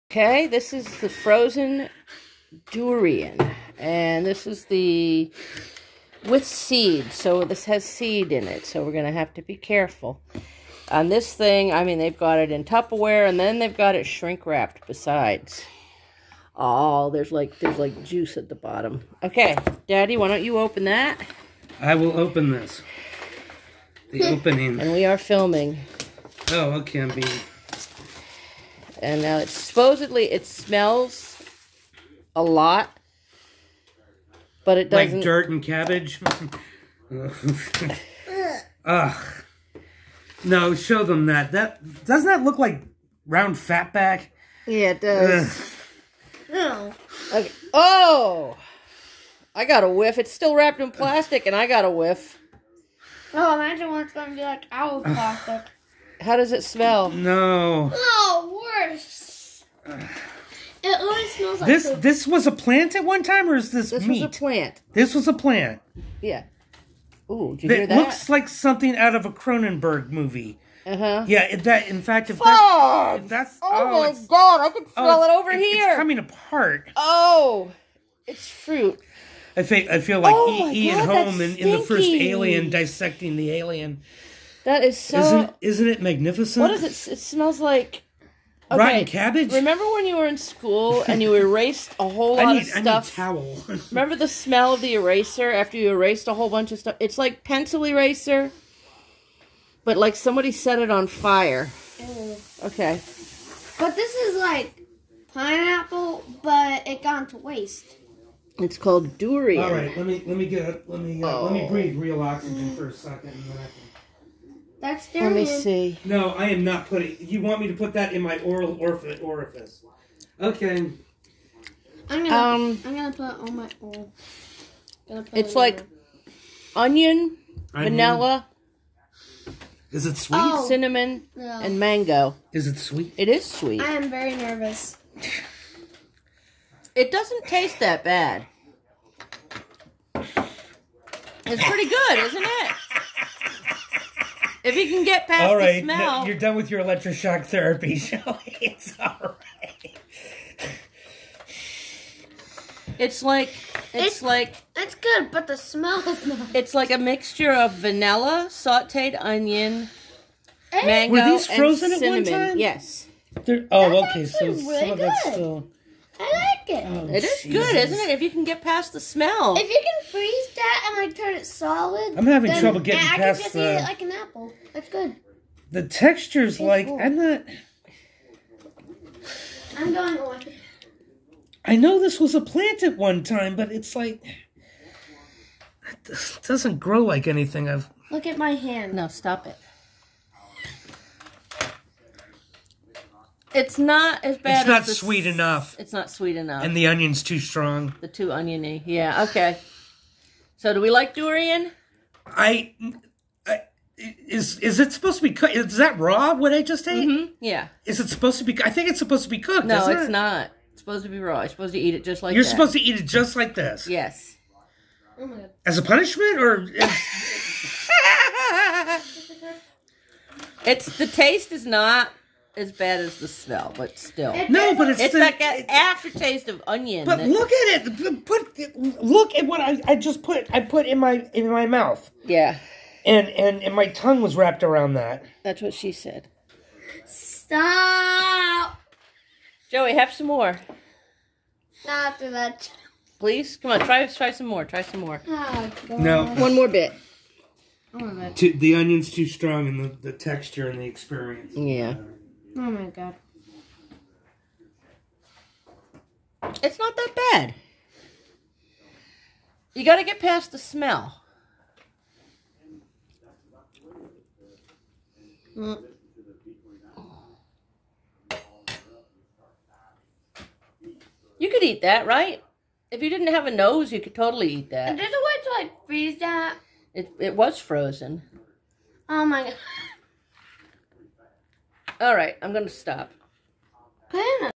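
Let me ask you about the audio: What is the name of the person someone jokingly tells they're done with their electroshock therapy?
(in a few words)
Shelly.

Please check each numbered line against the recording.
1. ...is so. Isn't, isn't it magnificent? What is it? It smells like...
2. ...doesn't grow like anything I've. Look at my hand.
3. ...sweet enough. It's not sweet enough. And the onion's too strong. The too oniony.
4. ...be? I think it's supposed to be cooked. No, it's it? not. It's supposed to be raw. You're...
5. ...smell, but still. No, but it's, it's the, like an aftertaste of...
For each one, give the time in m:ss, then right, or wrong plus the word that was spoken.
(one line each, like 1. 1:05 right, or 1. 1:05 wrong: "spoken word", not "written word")
1. 1:24 right
2. 3:06 right
3. 3:14 right
4. 3:28 right
5. 3:43 right.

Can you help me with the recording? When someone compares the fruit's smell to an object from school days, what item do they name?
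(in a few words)
Pencil eraser.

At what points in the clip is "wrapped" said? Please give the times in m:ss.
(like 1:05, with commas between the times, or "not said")
0:14, 0:50, 3:54.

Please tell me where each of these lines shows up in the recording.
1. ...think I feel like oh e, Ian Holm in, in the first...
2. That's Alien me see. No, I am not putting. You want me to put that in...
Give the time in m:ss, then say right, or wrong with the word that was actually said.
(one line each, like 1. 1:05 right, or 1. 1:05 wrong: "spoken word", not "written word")
1. 1:19 right
2. 1:54 wrong: "Let", not "Alien".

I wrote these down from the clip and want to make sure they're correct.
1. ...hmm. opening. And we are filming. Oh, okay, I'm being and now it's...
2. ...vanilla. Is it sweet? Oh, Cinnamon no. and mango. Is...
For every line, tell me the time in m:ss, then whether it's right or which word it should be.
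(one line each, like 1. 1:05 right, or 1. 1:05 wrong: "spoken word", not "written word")
1. 0:24 right
2. 2:07 right.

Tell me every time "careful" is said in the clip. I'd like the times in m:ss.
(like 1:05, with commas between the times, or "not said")
0:09.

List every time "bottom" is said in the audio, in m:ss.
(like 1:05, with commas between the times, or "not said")
0:18.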